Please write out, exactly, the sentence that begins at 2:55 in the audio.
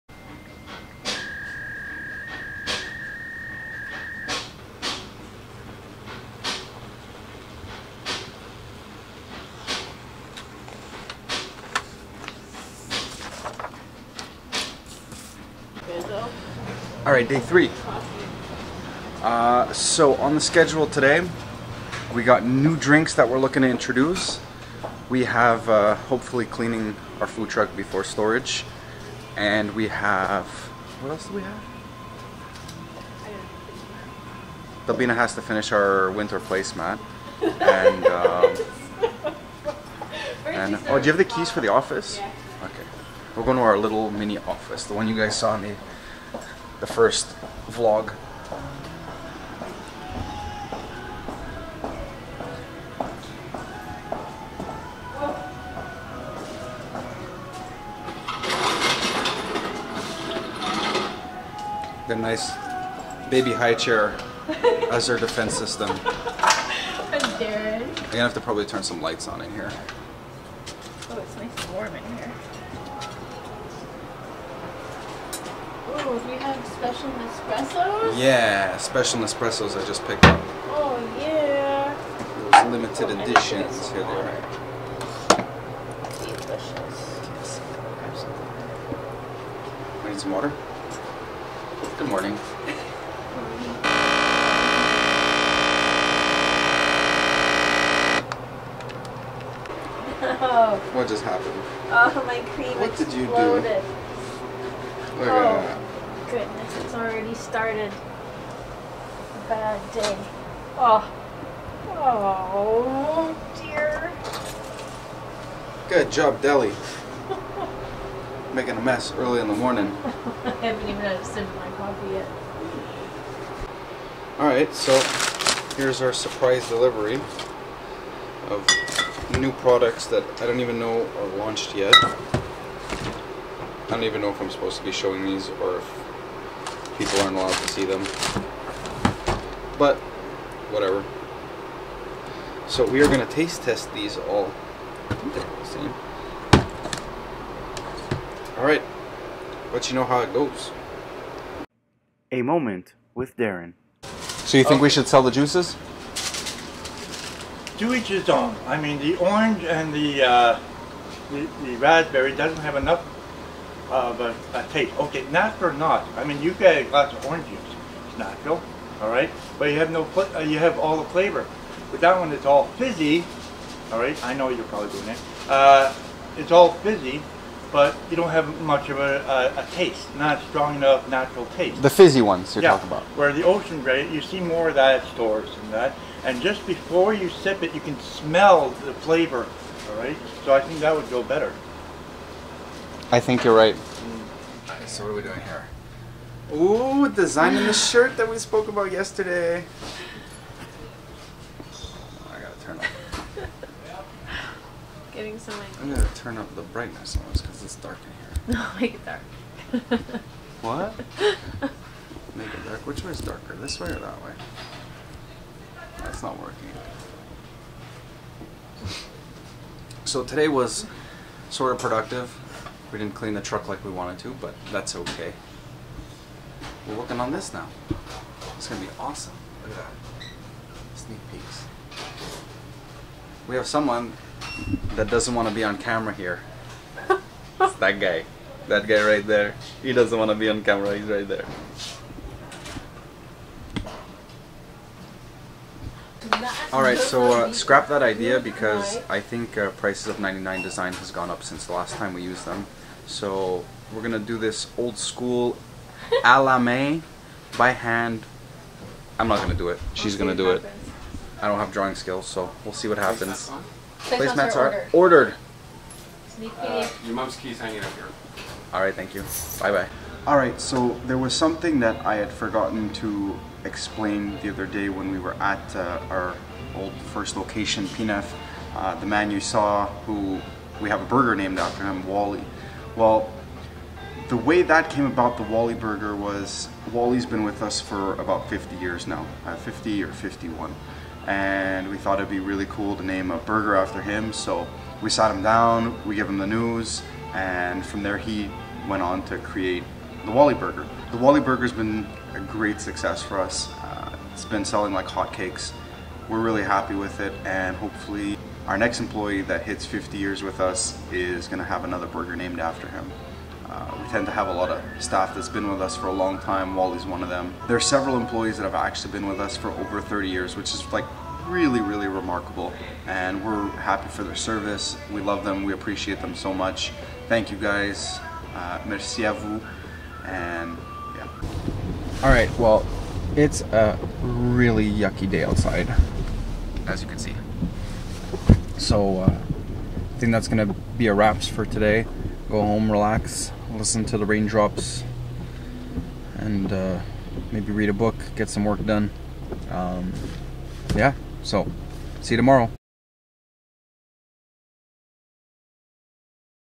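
Uh, it's all fizzy, but you don't have much of a, a, a, taste, not strong enough natural taste.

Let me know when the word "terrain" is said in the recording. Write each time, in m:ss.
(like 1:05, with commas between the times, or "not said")
not said.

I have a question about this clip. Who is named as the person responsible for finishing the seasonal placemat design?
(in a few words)
Delbina.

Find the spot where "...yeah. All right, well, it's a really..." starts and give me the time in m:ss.
5:31.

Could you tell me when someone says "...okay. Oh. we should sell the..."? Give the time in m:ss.
2:34.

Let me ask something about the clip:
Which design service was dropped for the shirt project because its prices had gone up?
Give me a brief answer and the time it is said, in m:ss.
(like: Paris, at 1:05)
99 design, at 4:10.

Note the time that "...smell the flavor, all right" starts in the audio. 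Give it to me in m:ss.
3:07.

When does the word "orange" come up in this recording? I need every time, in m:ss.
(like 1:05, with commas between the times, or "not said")
2:39, 2:47.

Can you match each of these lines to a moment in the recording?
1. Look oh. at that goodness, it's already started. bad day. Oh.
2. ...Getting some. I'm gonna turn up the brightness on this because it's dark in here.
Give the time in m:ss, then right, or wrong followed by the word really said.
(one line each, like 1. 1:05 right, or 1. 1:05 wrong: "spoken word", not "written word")
1. 1:45 right
2. 3:25 right.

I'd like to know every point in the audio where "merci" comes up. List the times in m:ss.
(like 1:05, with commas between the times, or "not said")
5:28.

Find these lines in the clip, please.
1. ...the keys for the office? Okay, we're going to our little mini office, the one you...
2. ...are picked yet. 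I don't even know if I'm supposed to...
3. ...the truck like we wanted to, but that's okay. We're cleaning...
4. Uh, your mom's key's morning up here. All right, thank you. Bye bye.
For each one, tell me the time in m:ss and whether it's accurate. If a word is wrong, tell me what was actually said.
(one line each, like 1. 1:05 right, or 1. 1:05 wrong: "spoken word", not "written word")
1. 0:41 right
2. 2:11 wrong: "launched", not "picked"
3. 3:43 wrong: "working", not "cleaning"
4. 4:26 wrong: "hanging", not "morning".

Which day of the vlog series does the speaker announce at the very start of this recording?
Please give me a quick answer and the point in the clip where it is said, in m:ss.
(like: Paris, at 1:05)
Day three, at 0:17.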